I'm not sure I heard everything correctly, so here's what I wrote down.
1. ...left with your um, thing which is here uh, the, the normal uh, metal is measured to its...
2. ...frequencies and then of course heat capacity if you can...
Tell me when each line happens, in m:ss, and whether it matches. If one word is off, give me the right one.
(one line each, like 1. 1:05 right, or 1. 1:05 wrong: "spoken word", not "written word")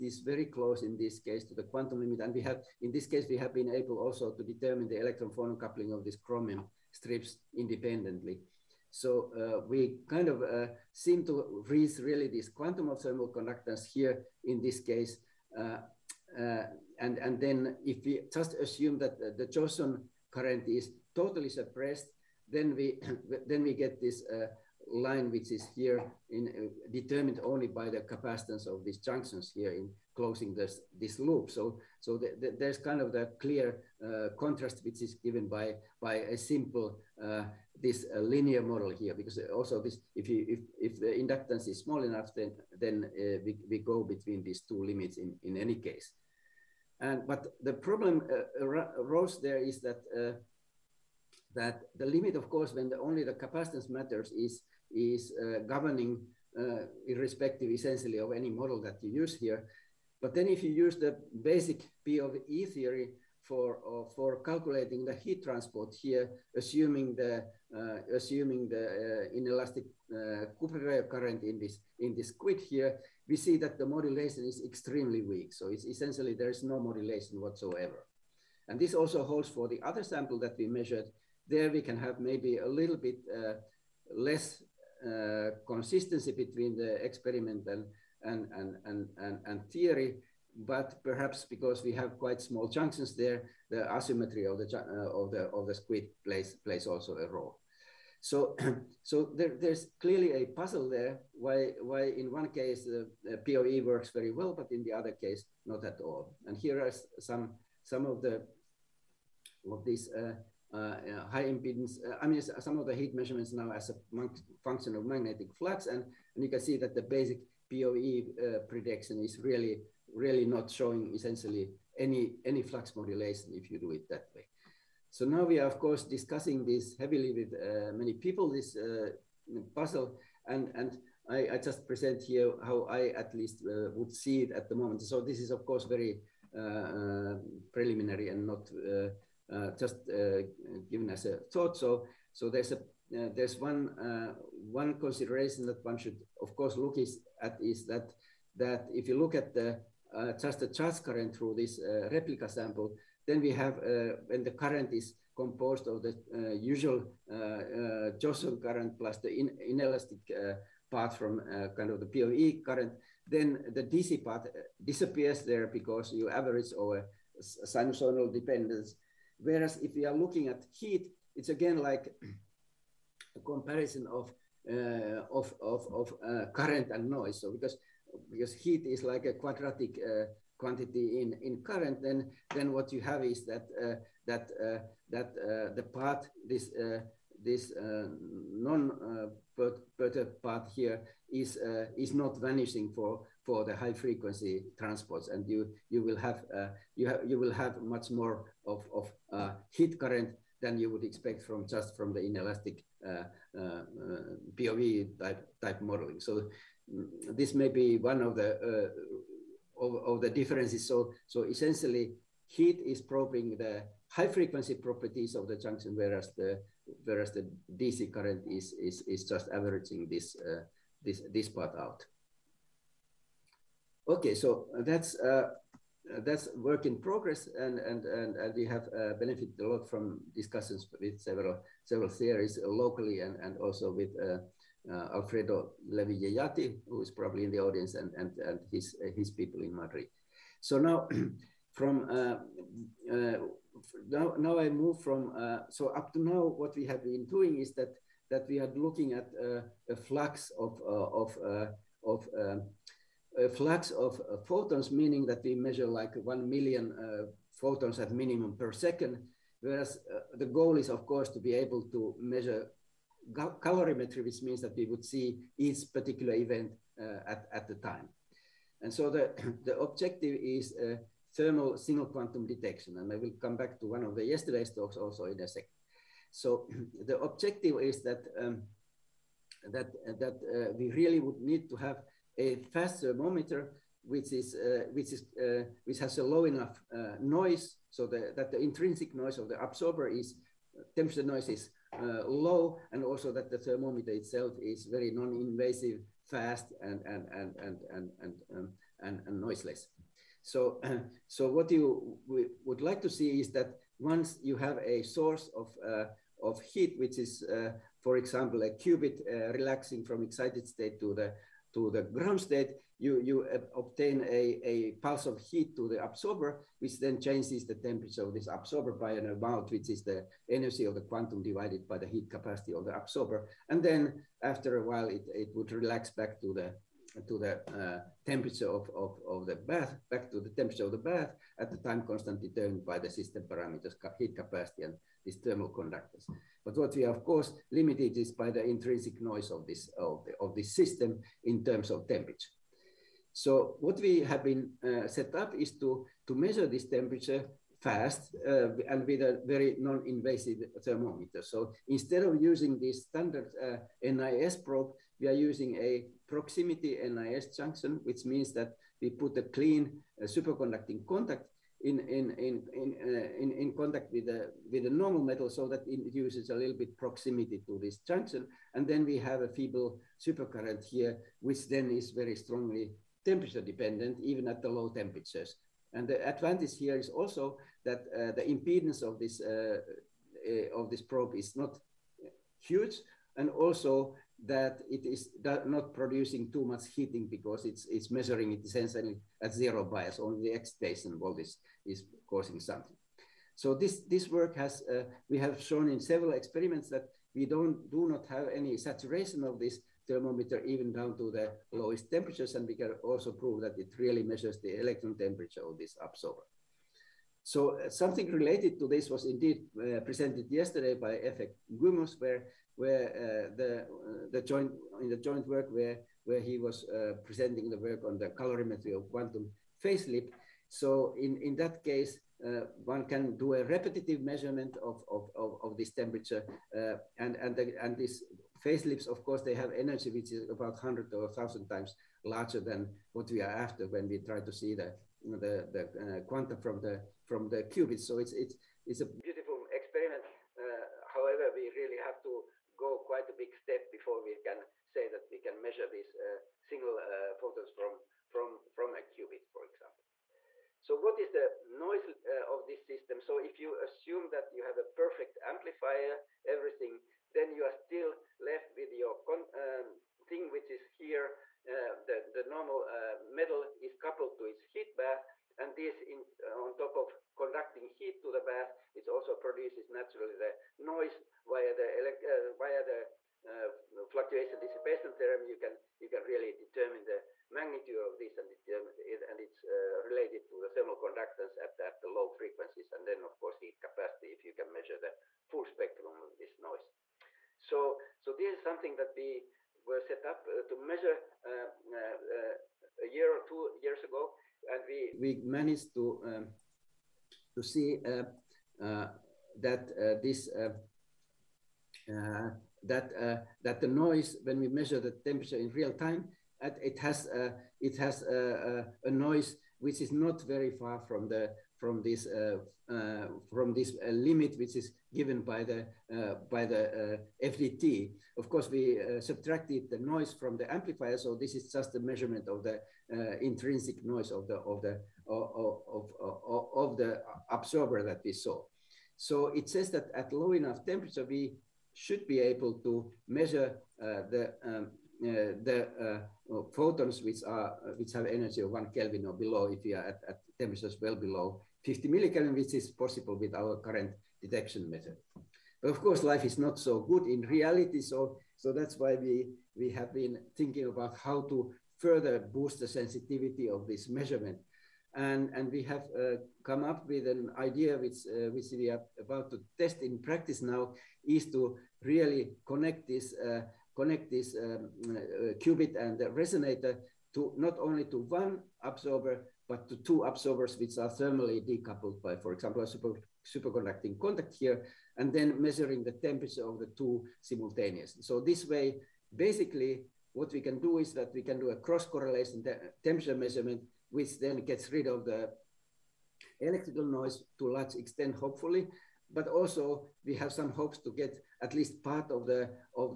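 1. 7:38 wrong: "coupled", not "measured"
2. 8:02 right.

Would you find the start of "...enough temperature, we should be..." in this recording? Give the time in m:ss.
8:50.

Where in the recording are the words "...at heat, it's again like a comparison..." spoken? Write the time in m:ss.
2:50.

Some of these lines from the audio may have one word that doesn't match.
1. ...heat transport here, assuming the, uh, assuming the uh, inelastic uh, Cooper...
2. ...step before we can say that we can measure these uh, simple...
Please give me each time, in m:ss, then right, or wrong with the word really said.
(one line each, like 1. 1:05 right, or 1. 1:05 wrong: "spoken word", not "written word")
1. 1:05 right
2. 7:23 wrong: "single", not "simple".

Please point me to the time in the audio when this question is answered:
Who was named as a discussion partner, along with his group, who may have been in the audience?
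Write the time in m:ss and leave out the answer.
3:55.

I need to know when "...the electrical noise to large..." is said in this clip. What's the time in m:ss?
9:45.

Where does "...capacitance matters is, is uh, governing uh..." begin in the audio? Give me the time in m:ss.
0:53.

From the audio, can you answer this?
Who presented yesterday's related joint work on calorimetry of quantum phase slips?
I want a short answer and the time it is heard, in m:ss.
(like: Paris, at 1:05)
Efek Gumus, at 6:51.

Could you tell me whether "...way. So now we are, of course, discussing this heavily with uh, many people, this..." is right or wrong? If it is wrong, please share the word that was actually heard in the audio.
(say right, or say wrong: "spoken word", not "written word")
right.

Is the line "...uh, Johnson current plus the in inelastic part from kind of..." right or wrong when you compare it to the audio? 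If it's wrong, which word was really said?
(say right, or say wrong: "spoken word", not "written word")
right.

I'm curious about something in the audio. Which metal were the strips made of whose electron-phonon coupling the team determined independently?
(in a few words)
chromium.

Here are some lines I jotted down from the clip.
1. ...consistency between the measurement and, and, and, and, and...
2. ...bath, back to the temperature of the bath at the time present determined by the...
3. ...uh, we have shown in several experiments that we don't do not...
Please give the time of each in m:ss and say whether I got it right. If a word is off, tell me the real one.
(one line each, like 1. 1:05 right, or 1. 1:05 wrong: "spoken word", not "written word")
1. 1:25 wrong: "experiment", not "measurement"
2. 5:29 wrong: "constant", not "present"
3. 6:34 right.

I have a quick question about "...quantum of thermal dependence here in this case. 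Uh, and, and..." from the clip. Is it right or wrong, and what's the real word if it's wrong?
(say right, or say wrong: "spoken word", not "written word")
wrong: "conductance", not "dependence".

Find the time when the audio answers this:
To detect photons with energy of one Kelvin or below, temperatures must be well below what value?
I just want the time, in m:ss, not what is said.
9:01.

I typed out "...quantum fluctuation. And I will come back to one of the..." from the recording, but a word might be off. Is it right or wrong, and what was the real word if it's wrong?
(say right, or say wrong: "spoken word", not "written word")
wrong: "detection", not "fluctuation".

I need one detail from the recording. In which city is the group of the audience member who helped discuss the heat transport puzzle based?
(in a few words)
Madrid.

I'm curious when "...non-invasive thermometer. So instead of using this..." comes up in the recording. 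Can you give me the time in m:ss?
5:49.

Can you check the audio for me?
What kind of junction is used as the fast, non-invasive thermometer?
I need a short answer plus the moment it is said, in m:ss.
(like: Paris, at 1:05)
proximity NIS junction, at 5:56.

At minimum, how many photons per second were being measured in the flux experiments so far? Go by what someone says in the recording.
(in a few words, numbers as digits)
1 million.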